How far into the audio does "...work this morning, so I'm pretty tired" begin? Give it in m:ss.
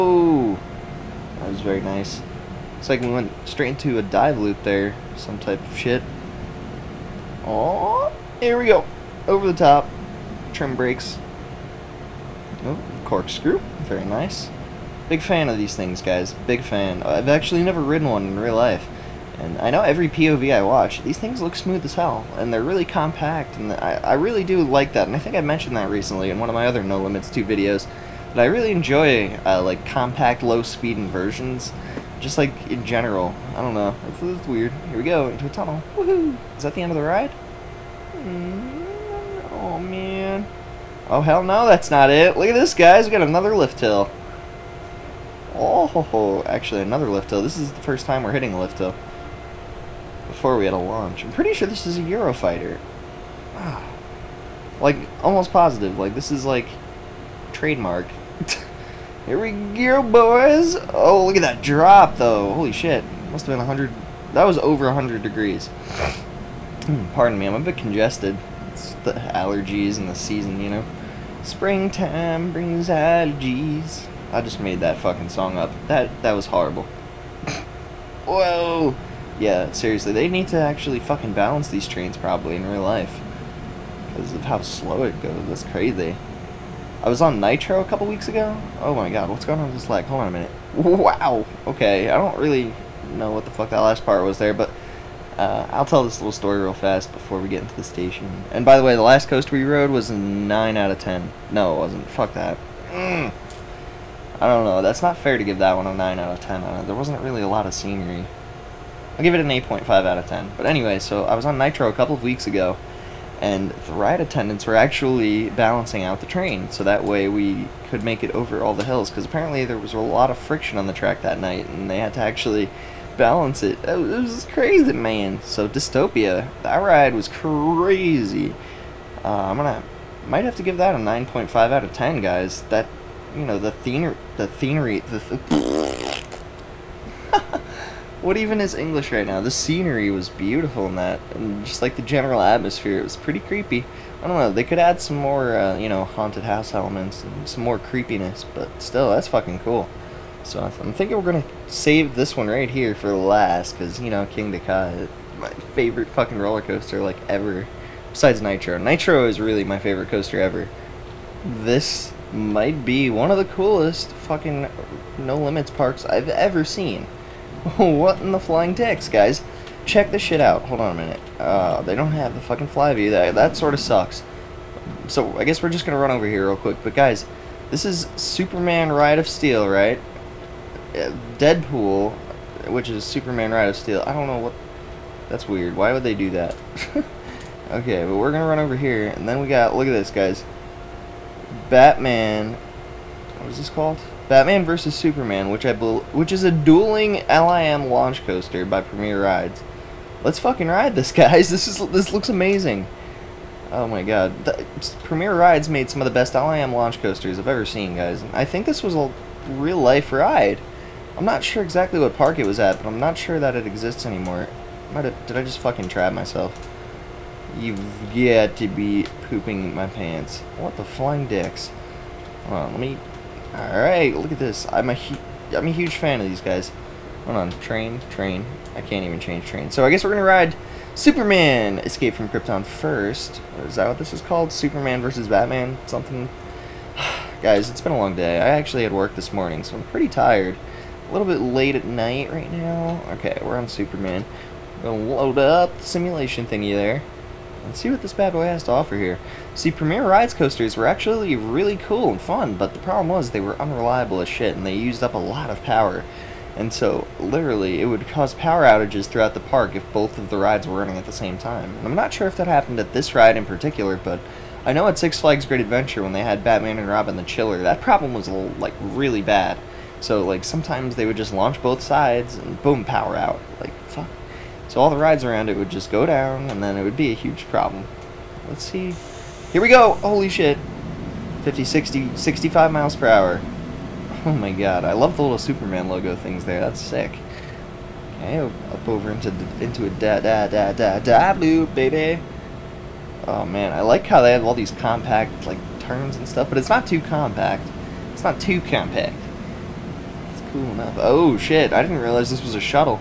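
3:58.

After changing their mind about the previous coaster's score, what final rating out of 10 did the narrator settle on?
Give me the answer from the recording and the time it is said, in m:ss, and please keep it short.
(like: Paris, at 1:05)
8.5, at 1:49.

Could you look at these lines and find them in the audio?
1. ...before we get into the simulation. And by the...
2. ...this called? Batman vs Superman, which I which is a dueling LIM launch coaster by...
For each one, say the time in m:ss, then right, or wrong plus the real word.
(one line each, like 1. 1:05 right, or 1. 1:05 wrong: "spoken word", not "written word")
1. 1:37 wrong: "station", not "simulation"
2. 3:13 right.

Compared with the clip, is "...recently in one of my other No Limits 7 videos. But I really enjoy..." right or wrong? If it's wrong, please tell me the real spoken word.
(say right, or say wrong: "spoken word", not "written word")
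wrong: "2", not "7".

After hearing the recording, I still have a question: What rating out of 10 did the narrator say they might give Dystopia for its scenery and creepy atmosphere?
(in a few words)
9.5.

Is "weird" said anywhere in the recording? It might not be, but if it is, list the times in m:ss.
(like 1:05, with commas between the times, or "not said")
0:34, 3:05.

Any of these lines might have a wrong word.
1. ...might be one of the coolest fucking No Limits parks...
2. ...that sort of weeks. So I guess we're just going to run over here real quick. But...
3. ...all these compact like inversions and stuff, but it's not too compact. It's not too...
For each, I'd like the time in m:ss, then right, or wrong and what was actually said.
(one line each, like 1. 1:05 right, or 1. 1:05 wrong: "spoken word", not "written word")
1. 2:42 right
2. 2:53 wrong: "sucks", not "weeks"
3. 4:54 wrong: "turns", not "inversions".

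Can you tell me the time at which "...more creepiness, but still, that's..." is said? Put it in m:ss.
2:27.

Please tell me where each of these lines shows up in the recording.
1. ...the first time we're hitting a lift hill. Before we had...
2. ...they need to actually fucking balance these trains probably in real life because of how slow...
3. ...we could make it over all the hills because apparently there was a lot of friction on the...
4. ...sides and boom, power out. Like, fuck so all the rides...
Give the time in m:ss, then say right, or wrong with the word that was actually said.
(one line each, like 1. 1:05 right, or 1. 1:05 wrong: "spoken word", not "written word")
1. 0:47 right
2. 1:20 right
3. 1:57 right
4. 4:31 right.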